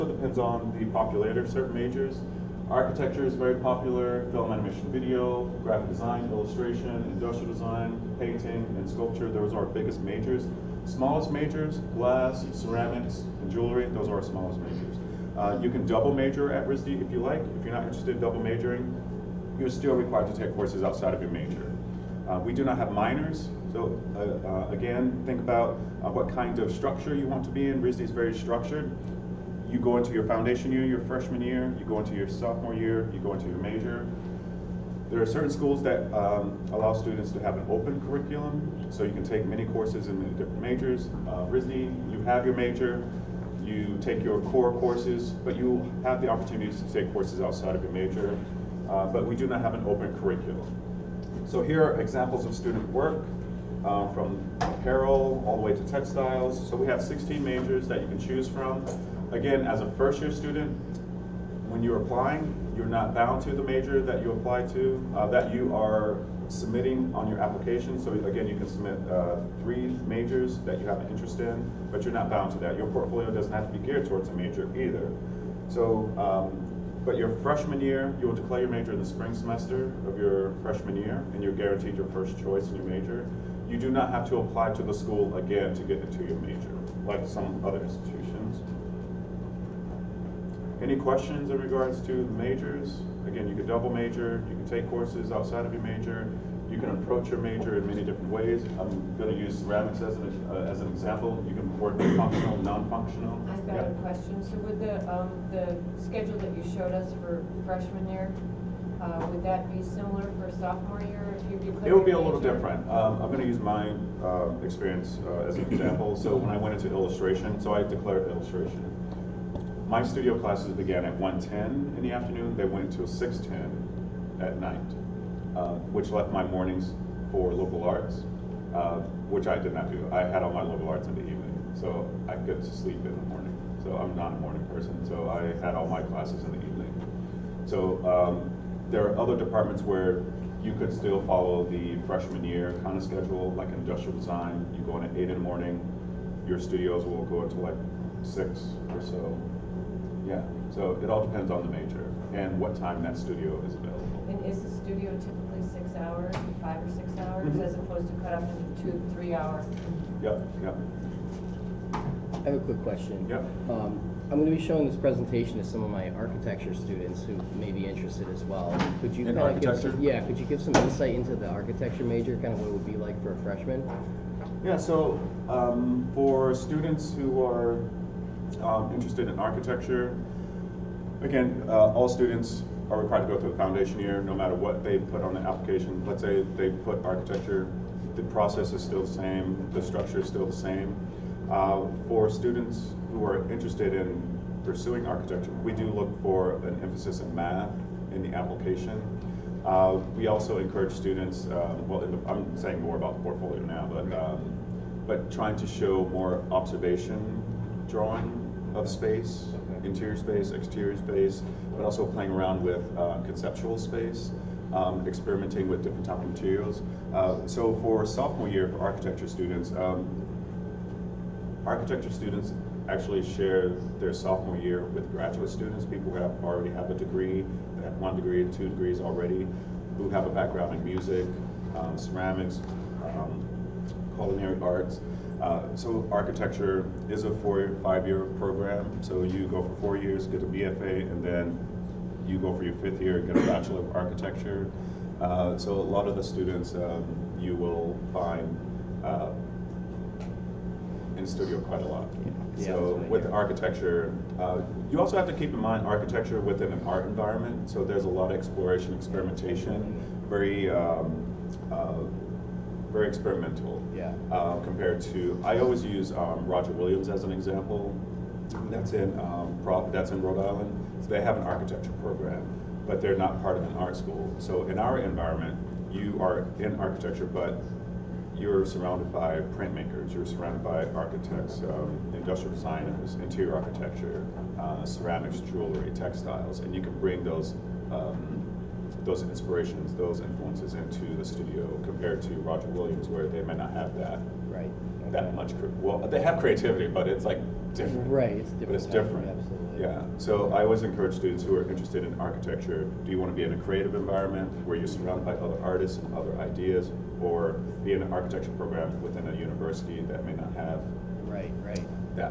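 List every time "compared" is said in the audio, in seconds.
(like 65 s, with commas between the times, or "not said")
264 s, 291 s.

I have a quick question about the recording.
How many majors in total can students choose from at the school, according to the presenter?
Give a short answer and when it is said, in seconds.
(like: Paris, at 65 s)
16, at 57 s.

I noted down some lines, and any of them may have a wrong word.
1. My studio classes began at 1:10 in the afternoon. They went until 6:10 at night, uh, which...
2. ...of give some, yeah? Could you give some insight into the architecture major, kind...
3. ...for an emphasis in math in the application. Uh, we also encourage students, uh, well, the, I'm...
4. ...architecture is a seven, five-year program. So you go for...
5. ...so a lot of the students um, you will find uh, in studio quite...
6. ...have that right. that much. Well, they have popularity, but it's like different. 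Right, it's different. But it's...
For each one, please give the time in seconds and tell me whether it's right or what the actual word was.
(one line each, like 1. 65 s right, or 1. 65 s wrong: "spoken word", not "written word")
1. 119 s right
2. 169 s right
3. 196 s right
4. 236 s wrong: "four", not "seven"
5. 245 s right
6. 293 s wrong: "creativity", not "popularity".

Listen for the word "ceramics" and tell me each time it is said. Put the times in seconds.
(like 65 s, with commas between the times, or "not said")
12 s, 99 s, 231 s, 284 s.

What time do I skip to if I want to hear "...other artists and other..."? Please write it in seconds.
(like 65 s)
305 s.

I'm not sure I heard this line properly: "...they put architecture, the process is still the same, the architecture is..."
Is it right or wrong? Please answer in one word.
wrong.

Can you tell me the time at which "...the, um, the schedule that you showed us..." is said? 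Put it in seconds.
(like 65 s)
104 s.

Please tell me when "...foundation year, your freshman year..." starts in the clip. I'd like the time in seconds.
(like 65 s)
30 s.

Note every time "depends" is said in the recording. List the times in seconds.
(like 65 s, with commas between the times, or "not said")
0 s, 151 s.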